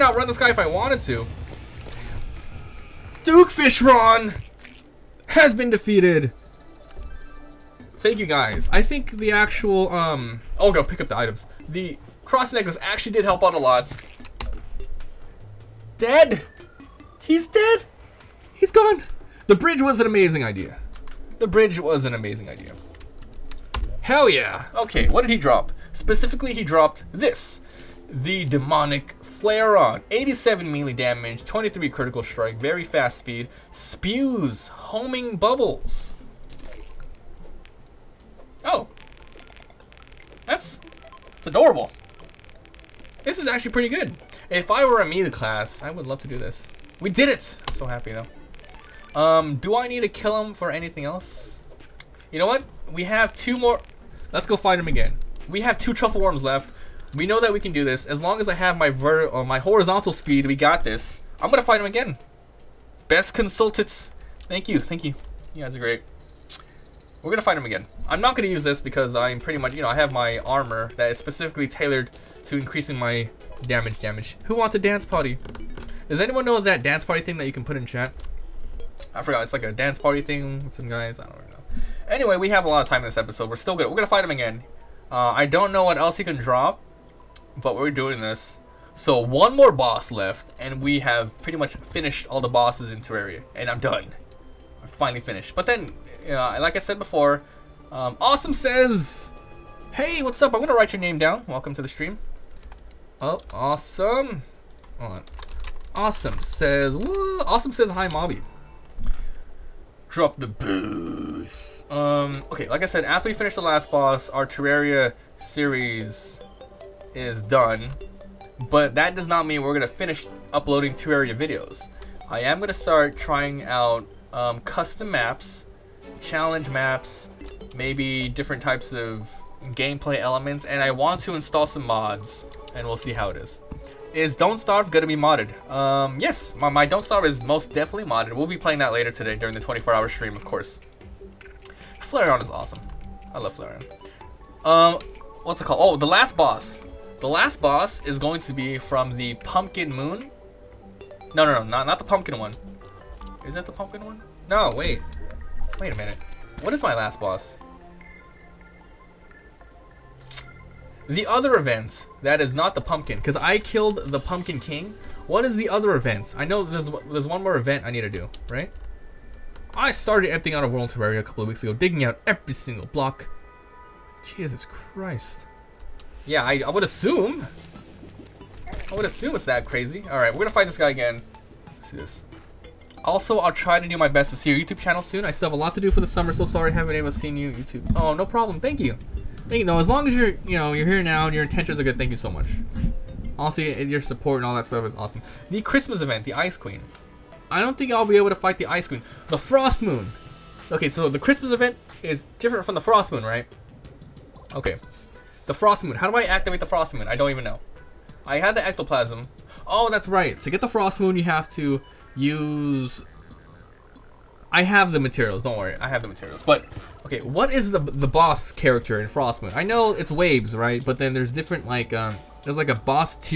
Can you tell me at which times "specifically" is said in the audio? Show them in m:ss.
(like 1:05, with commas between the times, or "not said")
0:25, 1:11.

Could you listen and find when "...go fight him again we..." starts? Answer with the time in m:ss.
0:54.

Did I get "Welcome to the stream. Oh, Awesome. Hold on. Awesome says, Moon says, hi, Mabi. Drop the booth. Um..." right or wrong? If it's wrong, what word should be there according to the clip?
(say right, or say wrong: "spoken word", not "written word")
wrong: "Awesome", not "Moon".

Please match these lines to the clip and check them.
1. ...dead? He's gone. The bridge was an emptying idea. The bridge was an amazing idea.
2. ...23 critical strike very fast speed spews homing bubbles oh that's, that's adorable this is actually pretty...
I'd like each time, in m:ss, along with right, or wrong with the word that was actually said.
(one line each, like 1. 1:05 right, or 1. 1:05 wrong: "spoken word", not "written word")
1. 0:17 wrong: "amazing", not "emptying"
2. 0:31 right.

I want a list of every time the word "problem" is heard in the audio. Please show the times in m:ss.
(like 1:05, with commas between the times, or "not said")
3:08.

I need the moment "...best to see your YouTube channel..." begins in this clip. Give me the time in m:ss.
3:04.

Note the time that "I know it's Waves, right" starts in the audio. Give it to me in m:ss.
3:39.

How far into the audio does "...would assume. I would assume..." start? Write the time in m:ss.
2:56.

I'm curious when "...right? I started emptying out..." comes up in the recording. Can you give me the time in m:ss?
2:48.